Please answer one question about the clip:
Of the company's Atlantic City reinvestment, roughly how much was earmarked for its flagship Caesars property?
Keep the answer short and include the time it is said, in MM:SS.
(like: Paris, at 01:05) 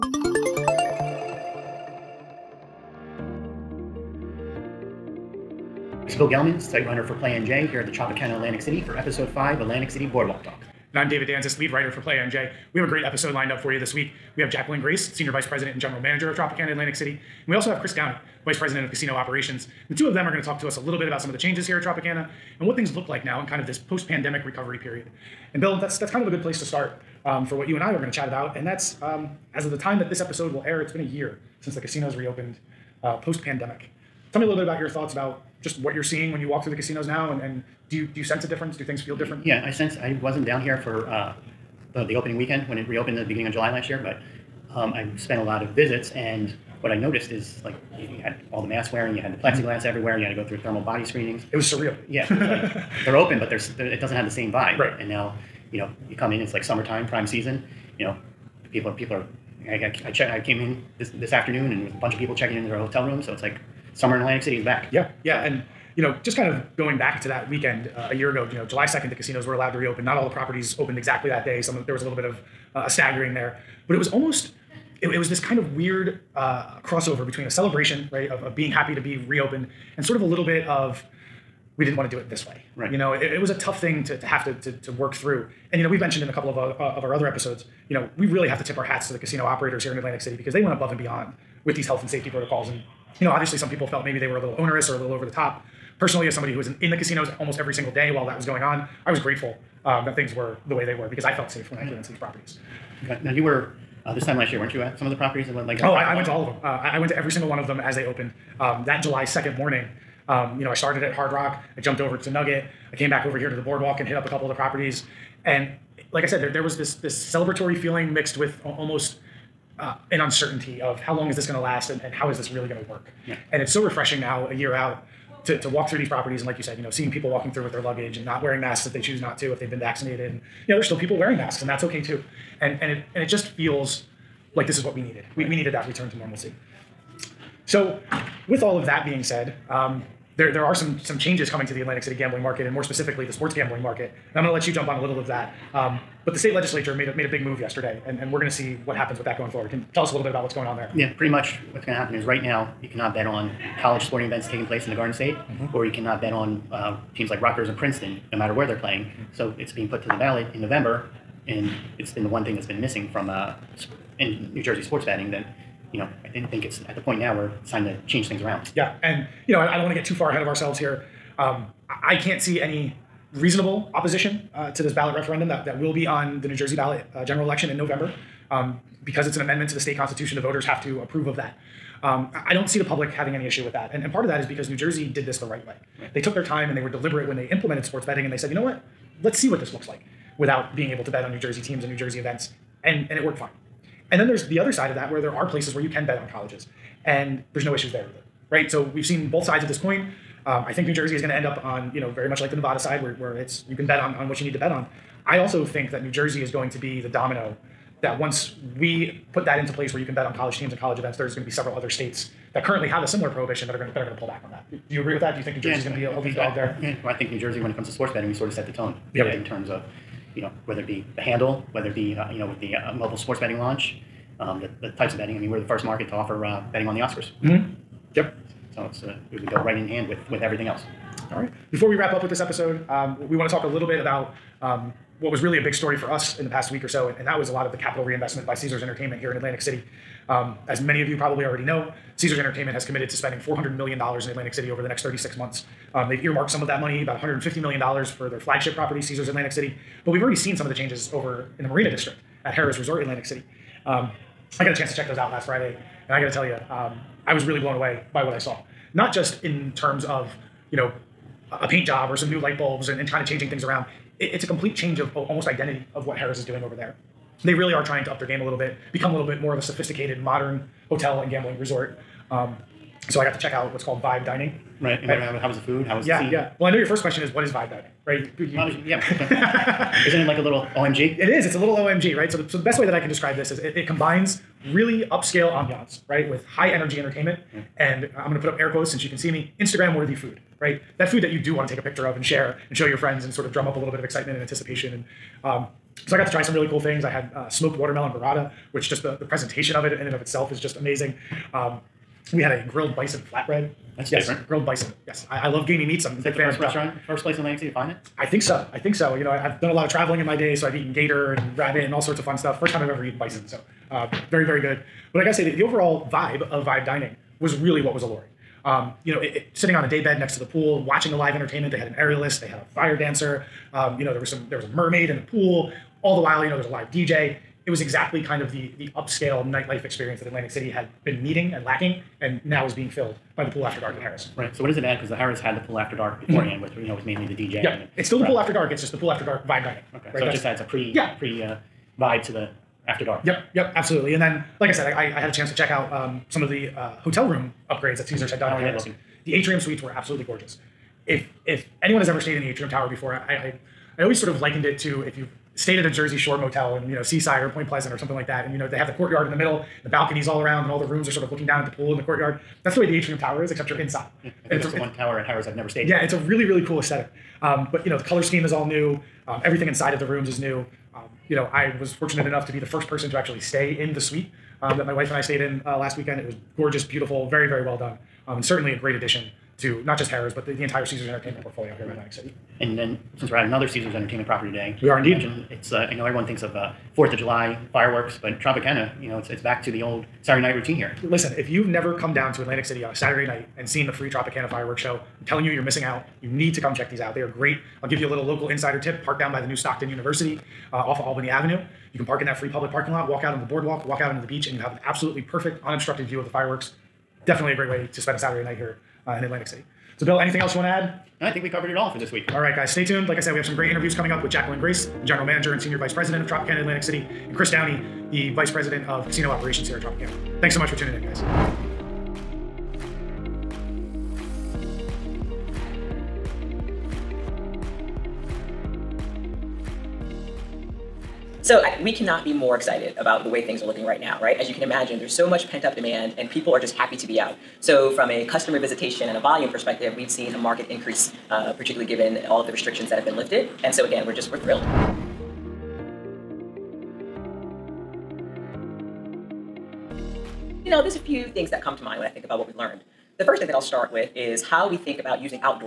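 $150 million, at 04:07.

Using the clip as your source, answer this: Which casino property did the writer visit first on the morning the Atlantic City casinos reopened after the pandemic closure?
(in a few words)
Hard Rock.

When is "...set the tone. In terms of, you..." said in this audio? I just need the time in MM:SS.
03:38.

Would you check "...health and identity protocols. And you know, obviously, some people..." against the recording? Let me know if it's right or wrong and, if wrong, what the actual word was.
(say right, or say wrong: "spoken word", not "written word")
wrong: "safety", not "identity".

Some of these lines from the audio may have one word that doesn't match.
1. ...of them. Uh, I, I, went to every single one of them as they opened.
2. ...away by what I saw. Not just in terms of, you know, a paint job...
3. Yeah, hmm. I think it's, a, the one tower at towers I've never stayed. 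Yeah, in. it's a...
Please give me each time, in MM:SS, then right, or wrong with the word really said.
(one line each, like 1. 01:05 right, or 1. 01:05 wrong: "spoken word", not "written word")
1. 01:46 right
2. 04:17 right
3. 06:04 right.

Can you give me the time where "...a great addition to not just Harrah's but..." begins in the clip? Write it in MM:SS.
06:18.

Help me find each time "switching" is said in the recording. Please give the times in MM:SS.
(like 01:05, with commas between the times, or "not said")
not said.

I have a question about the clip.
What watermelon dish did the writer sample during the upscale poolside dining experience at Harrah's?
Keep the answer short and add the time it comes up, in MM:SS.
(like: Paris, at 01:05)
smoked watermelon burrata, at 04:57.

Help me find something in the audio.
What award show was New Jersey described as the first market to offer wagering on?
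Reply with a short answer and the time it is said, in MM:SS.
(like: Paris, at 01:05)
the Oscars, at 03:46.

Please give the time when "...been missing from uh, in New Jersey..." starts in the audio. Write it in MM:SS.
02:42.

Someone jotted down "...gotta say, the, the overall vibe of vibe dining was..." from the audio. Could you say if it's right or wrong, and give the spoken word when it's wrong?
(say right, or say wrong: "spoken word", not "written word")
right.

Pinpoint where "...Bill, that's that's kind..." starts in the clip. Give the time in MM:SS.
00:25.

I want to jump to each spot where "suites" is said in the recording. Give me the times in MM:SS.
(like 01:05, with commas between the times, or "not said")
05:49, 06:13.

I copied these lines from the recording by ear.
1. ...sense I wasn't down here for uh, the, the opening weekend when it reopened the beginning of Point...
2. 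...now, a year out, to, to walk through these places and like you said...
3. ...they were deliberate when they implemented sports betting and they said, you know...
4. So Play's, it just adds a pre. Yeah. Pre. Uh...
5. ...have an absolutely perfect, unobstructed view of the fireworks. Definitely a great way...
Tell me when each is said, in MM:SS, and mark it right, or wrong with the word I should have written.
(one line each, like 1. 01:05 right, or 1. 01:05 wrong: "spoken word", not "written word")
1. 00:39 wrong: "July", not "Point"
2. 02:04 wrong: "properties", not "places"
3. 03:06 right
4. 05:40 wrong: "That", not "Play"
5. 06:44 right.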